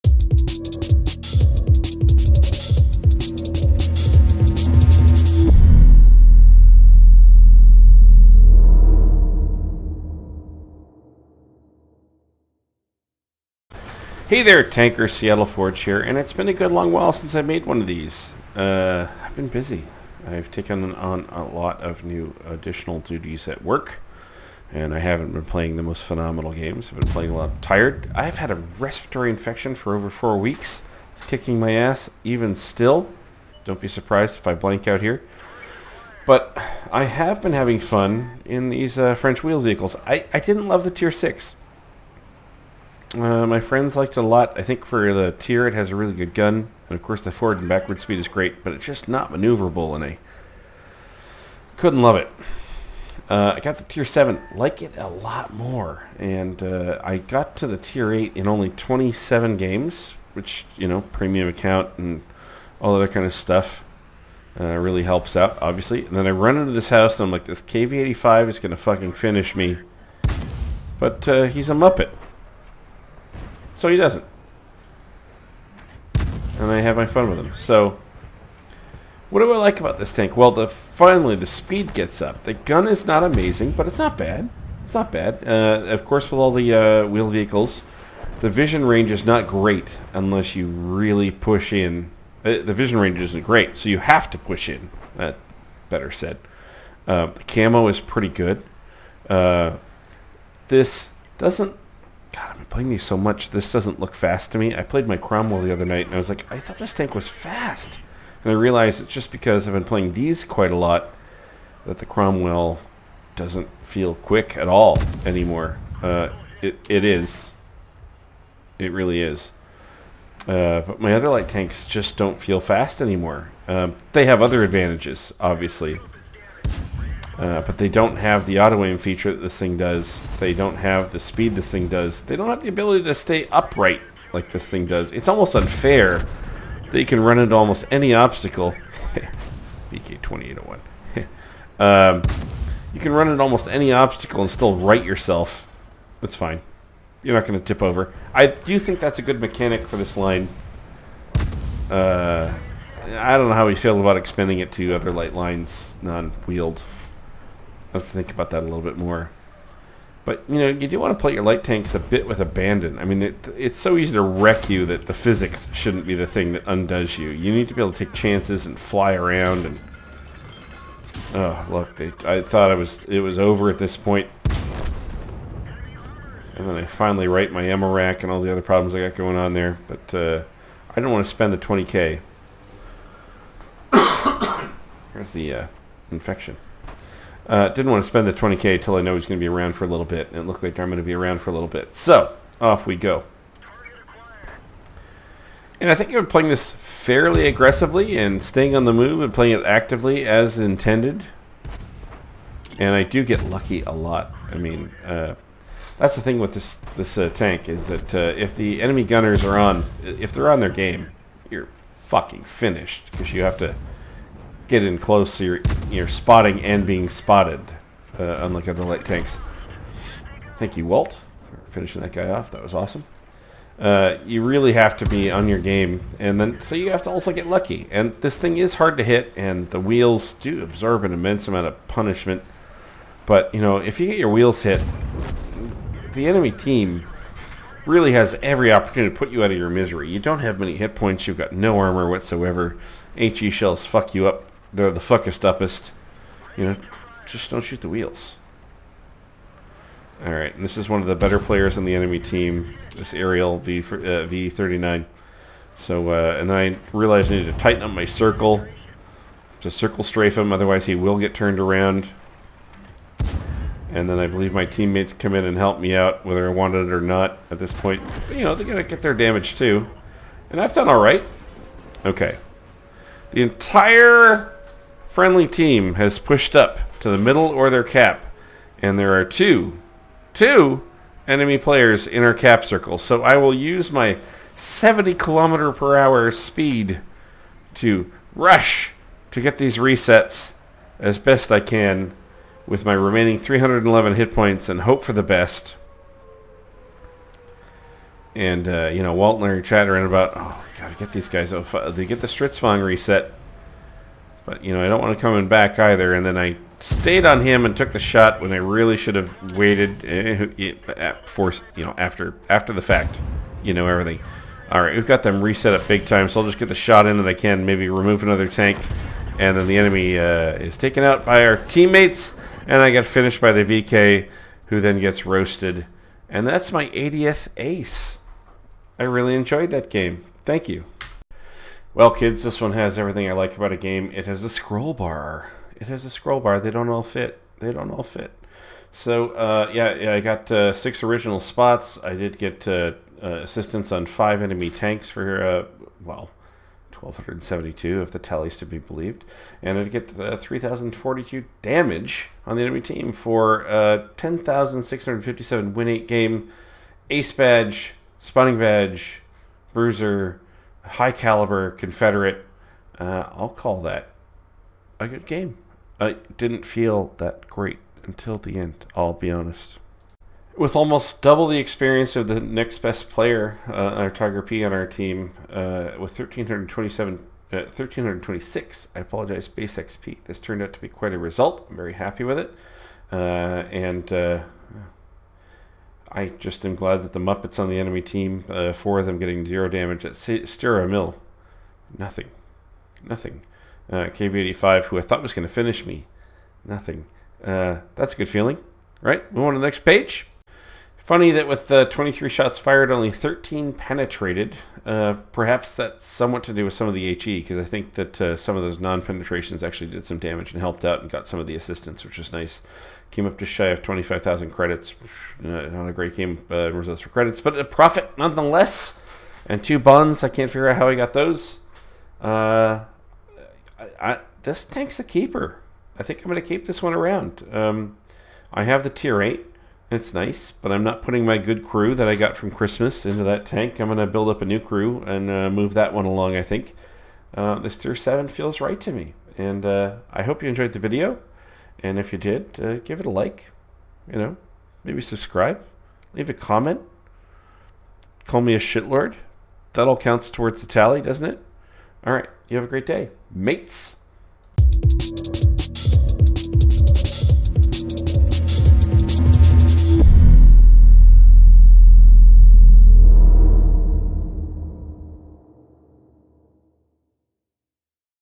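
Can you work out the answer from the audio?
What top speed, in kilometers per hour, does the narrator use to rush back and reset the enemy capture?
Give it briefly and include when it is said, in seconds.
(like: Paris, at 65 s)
70, at 284 s.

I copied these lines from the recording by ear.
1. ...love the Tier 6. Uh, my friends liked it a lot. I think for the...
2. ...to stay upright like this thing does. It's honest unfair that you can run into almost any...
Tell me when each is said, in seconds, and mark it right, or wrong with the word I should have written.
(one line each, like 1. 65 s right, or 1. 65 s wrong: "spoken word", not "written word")
1. 40 s right
2. 133 s wrong: "almost", not "honest".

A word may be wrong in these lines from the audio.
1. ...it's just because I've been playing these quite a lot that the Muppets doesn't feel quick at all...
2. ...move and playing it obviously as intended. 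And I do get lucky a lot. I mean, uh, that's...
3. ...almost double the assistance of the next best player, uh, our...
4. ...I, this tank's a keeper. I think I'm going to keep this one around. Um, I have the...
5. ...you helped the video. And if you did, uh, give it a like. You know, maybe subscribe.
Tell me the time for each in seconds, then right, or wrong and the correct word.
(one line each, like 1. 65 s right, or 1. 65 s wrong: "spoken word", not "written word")
1. 109 s wrong: "Cromwell", not "Muppets"
2. 198 s wrong: "actively", not "obviously"
3. 370 s wrong: "experience", not "assistance"
4. 424 s right
5. 440 s wrong: "enjoyed", not "helped".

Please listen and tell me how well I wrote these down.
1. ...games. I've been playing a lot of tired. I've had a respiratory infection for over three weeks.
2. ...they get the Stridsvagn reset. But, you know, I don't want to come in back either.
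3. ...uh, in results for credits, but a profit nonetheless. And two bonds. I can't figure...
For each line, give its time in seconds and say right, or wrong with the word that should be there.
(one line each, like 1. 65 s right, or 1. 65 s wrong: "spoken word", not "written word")
1. 26 s wrong: "four", not "three"
2. 301 s right
3. 416 s right.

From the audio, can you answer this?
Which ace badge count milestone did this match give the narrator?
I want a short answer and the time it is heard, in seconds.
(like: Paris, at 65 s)
80th, at 326 s.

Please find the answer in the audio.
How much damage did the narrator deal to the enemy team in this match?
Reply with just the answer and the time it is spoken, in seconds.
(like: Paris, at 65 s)
3,042, at 350 s.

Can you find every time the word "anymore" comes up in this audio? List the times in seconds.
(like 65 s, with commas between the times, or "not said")
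115 s, 123 s.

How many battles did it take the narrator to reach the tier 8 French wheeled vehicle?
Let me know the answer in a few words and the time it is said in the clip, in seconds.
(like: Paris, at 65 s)
27, at 58 s.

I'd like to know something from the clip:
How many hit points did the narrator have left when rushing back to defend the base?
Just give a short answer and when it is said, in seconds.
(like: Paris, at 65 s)
311, at 293 s.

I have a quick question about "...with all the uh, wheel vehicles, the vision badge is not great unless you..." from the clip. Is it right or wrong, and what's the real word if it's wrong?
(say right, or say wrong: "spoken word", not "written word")
wrong: "range", not "badge".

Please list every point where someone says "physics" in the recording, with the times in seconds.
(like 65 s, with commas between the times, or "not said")
165 s.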